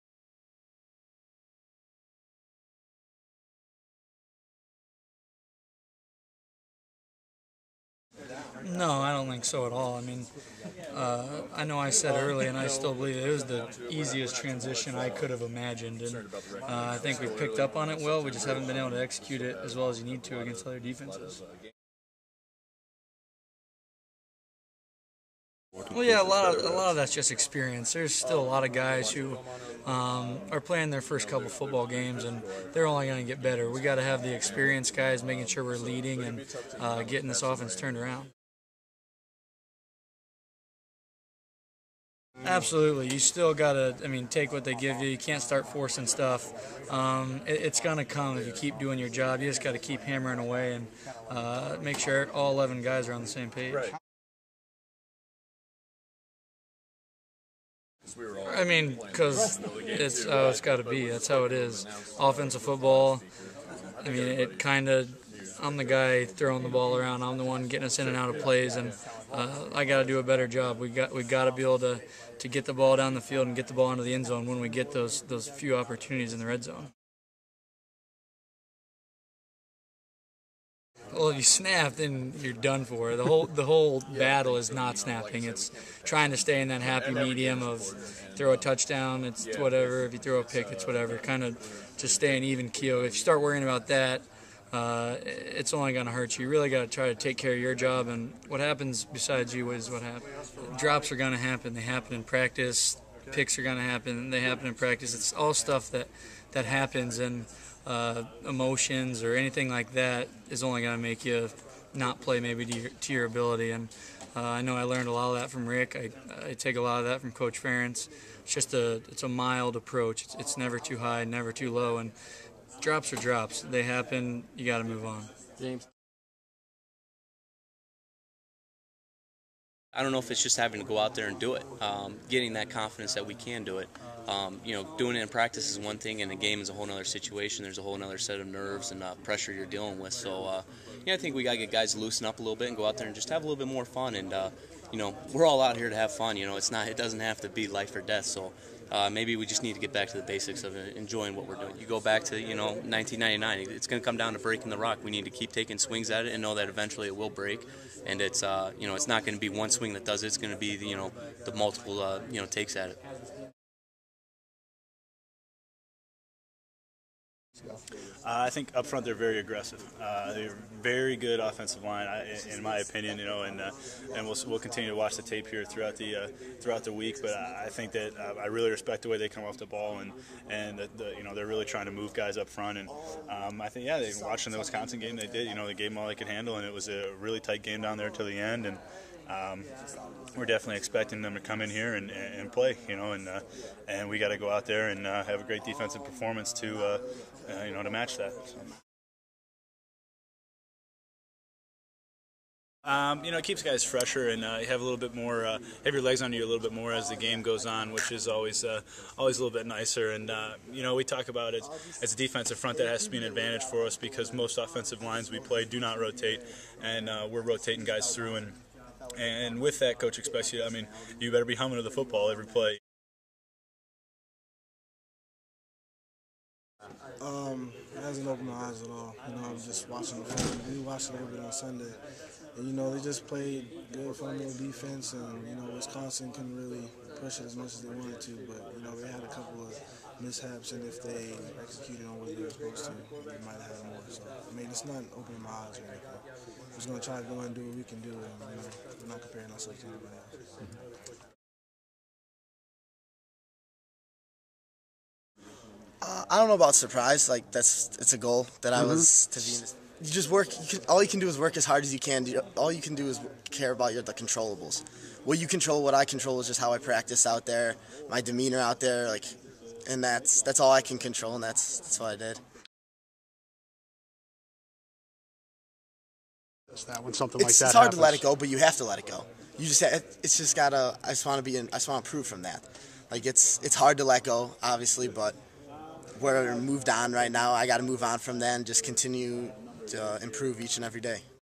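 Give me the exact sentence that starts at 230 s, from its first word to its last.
we watched a little bit on Sunday.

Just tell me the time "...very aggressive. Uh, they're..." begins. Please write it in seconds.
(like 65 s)
169 s.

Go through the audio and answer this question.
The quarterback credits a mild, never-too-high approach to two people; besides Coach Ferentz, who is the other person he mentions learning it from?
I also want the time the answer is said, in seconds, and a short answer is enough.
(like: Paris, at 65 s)
Rick, at 115 s.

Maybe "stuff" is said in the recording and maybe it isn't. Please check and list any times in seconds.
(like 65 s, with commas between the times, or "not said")
46 s, 105 s.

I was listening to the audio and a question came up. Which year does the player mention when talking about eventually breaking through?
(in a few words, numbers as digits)
1999.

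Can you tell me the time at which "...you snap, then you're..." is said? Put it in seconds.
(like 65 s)
81 s.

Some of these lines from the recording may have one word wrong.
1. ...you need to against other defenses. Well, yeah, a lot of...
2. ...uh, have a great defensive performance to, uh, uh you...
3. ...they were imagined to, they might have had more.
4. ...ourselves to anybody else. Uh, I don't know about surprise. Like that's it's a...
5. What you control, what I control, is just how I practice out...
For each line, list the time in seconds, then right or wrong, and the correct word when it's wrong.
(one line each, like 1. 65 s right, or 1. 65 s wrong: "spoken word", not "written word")
1. 19 s right
2. 195 s right
3. 242 s wrong: "supposed", not "imagined"
4. 249 s right
5. 265 s right.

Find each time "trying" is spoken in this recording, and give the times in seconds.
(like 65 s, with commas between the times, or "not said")
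86 s, 181 s.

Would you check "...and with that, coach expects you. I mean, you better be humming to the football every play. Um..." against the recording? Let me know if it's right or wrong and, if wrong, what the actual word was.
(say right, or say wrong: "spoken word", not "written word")
right.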